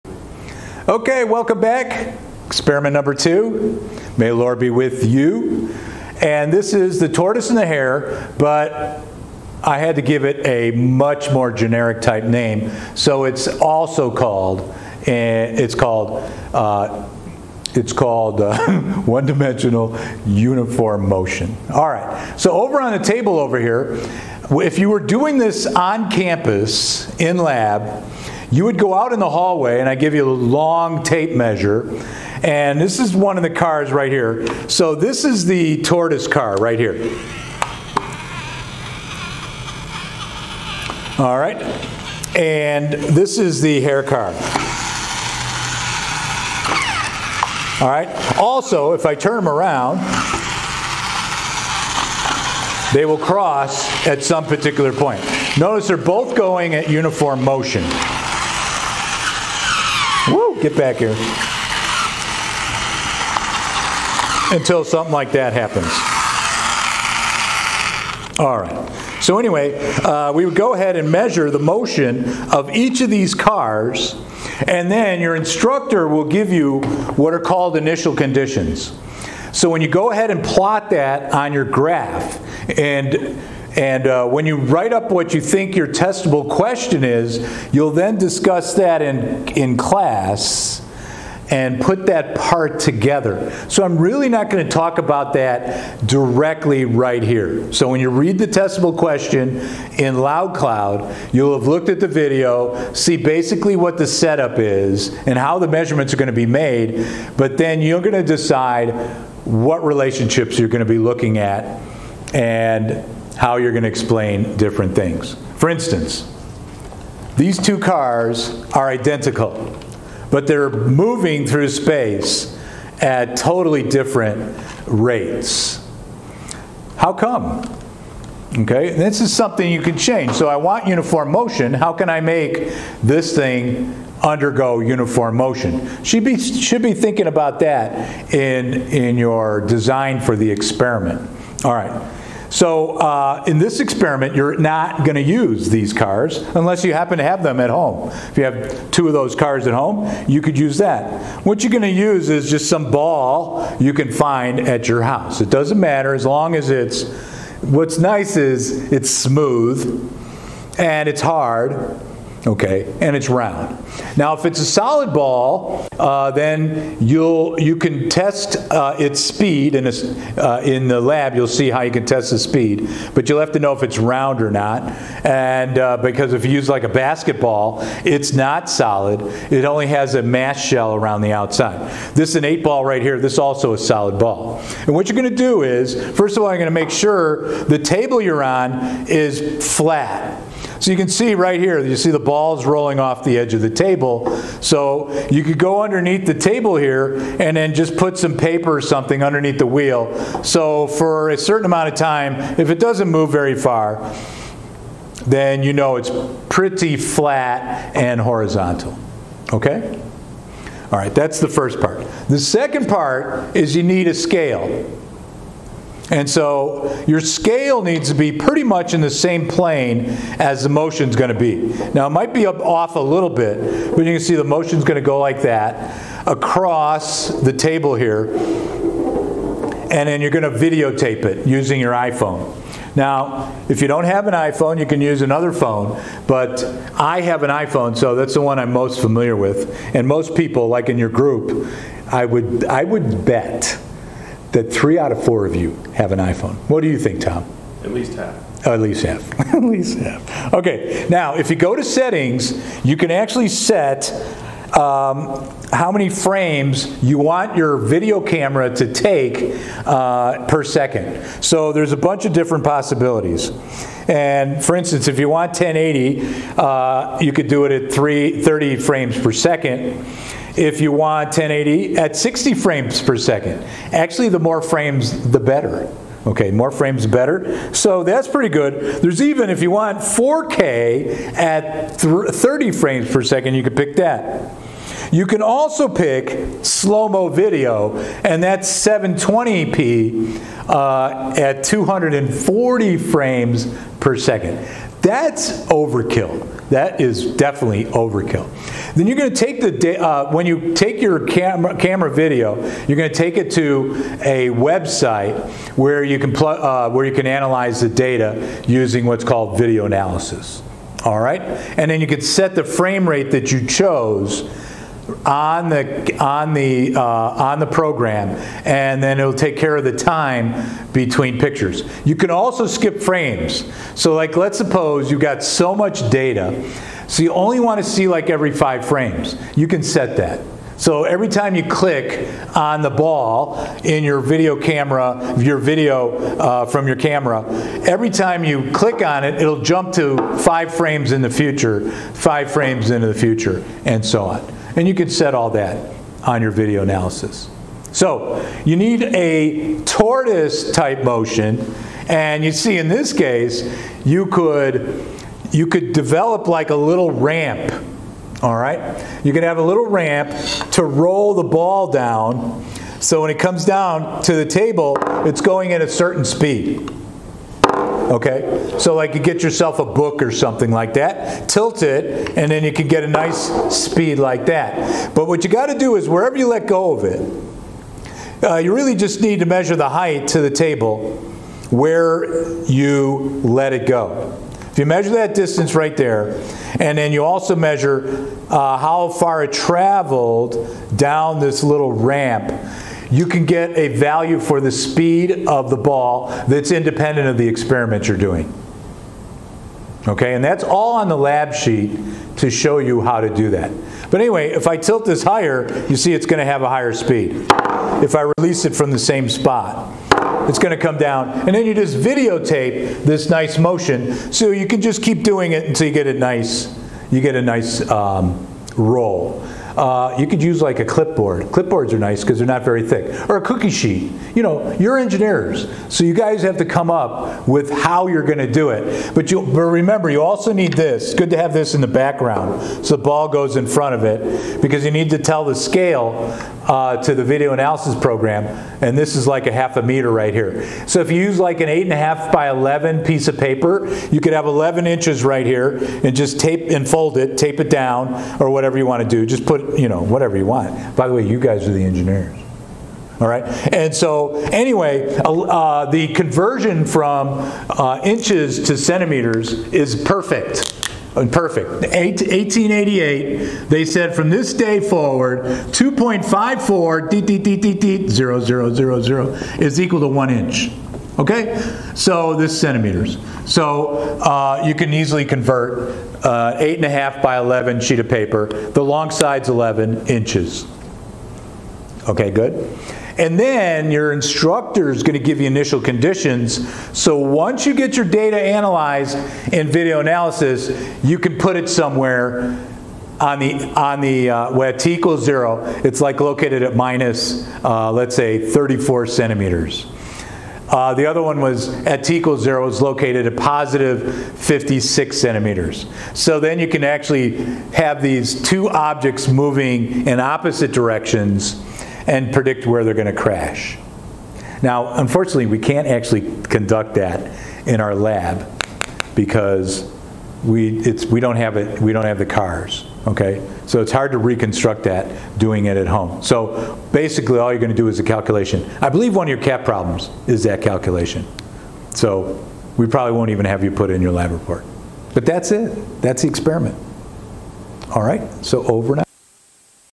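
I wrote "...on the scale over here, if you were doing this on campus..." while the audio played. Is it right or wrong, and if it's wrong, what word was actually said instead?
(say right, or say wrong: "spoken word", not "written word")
wrong: "table", not "scale".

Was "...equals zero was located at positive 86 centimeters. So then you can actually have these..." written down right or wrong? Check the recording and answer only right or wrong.
wrong.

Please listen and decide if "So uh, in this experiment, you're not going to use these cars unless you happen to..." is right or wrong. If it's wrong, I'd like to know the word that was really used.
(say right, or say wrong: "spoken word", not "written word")
right.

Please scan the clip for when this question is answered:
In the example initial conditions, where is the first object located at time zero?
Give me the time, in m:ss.
8:16.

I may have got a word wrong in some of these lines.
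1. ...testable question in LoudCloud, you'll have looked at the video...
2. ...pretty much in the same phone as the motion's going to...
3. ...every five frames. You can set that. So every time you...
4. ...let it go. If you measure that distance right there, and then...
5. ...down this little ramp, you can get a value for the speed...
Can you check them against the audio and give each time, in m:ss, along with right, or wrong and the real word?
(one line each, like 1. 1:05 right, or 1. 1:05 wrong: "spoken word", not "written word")
1. 1:38 right
2. 3:38 wrong: "plane", not "phone"
3. 5:28 right
4. 6:23 right
5. 6:30 right.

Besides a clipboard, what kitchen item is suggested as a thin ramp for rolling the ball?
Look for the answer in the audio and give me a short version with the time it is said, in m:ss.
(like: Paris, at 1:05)
Cookie sheet, at 7:03.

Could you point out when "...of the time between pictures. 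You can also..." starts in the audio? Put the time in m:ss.
5:19.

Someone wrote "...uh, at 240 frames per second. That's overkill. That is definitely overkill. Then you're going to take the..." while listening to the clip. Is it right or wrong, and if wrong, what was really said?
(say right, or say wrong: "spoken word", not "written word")
right.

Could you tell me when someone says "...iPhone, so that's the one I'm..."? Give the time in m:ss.
3:57.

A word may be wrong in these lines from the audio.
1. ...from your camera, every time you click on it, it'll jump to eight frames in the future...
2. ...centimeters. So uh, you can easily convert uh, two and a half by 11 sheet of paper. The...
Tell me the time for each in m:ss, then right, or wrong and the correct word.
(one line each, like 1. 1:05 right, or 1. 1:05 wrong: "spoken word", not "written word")
1. 5:36 wrong: "five", not "eight"
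2. 7:52 wrong: "eight", not "two".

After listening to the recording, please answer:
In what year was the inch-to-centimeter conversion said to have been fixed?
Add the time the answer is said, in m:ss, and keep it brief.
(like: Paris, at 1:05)
1888, at 7:41.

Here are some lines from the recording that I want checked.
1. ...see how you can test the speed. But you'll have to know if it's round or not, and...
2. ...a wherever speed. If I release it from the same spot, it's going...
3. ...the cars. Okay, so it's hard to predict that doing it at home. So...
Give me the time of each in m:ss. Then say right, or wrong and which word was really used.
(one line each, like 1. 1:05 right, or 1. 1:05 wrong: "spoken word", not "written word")
1. 2:51 right
2. 6:46 wrong: "higher", not "wherever"
3. 8:42 wrong: "reconstruct", not "predict".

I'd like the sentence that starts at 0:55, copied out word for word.
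Notice they're both going at uniform motion.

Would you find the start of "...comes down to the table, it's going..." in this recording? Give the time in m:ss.
6:03.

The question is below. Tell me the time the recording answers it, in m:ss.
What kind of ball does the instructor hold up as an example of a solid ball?
3:02.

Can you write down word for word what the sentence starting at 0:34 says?
So this is the tortoise car right here.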